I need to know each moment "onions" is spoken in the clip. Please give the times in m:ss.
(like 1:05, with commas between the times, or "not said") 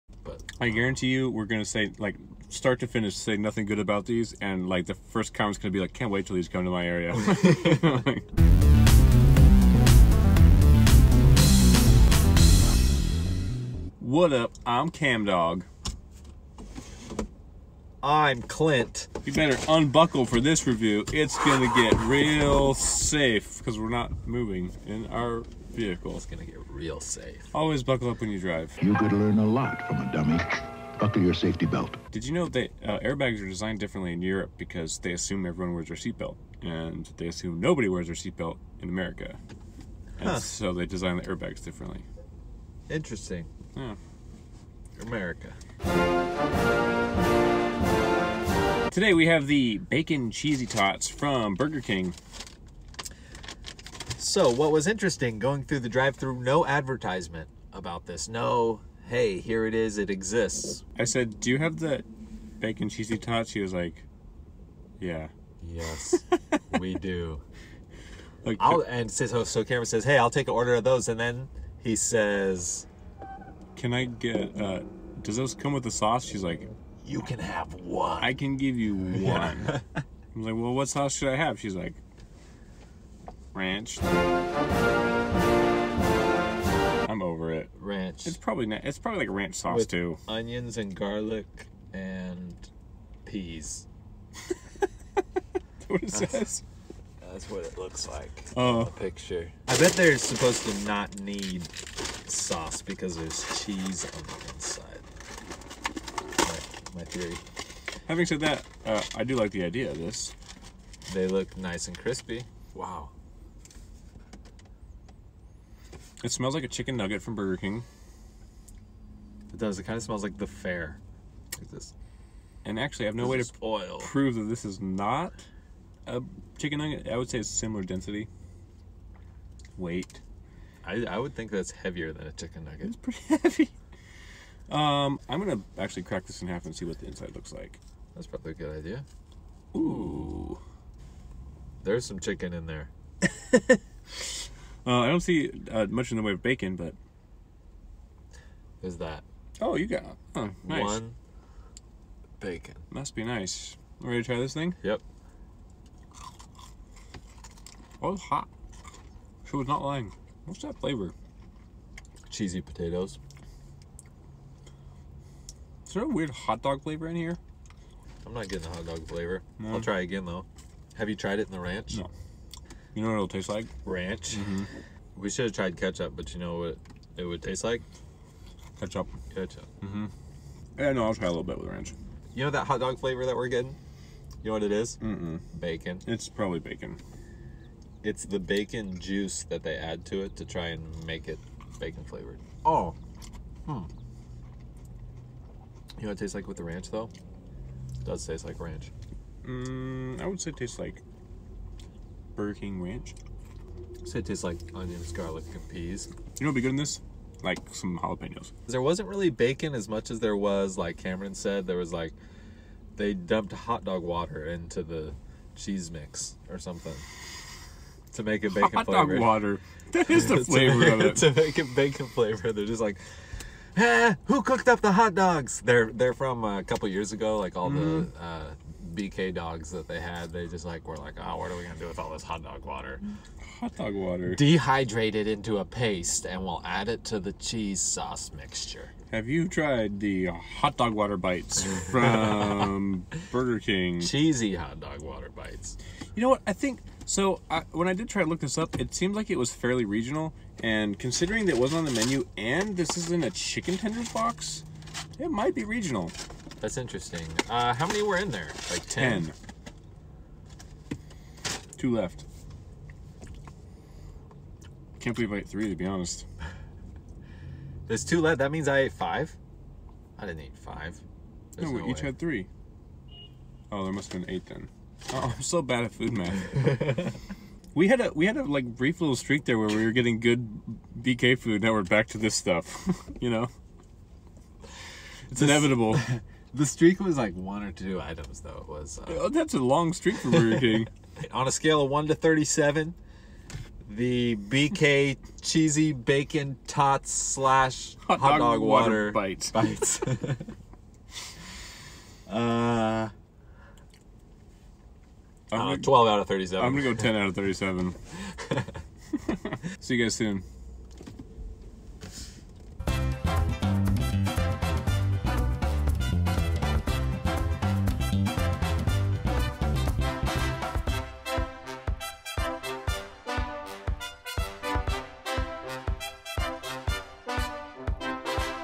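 1:30, 3:24.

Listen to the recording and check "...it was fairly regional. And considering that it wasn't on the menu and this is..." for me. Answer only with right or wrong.
right.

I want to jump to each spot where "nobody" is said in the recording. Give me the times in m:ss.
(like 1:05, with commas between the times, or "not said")
0:37.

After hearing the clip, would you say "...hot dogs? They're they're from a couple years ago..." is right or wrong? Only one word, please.
right.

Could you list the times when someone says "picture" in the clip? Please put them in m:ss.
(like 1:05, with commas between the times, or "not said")
1:38.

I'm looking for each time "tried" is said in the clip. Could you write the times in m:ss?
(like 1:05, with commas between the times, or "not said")
2:51, 2:55, 3:59.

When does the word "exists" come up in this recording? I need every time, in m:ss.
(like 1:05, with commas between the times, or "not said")
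1:00.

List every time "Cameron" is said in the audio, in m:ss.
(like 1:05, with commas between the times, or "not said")
1:09, 3:30.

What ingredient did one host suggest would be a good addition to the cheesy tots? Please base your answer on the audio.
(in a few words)
Jalapenos.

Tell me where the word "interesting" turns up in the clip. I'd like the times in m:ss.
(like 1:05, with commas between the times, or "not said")
0:42, 0:54, 4:16.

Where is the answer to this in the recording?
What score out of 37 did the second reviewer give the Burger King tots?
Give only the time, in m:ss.
5:07.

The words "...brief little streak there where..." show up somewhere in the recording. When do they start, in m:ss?
4:38.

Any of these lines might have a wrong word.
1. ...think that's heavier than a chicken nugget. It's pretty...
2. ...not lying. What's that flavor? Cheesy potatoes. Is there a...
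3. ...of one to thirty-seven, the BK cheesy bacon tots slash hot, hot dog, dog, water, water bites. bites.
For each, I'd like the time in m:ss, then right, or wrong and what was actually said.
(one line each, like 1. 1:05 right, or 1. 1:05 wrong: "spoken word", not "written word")
1. 2:11 right
2. 2:39 right
3. 4:51 right.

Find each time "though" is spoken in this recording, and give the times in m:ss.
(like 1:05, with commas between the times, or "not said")
2:50, 3:16, 4:48.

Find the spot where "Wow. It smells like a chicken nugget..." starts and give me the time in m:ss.
1:52.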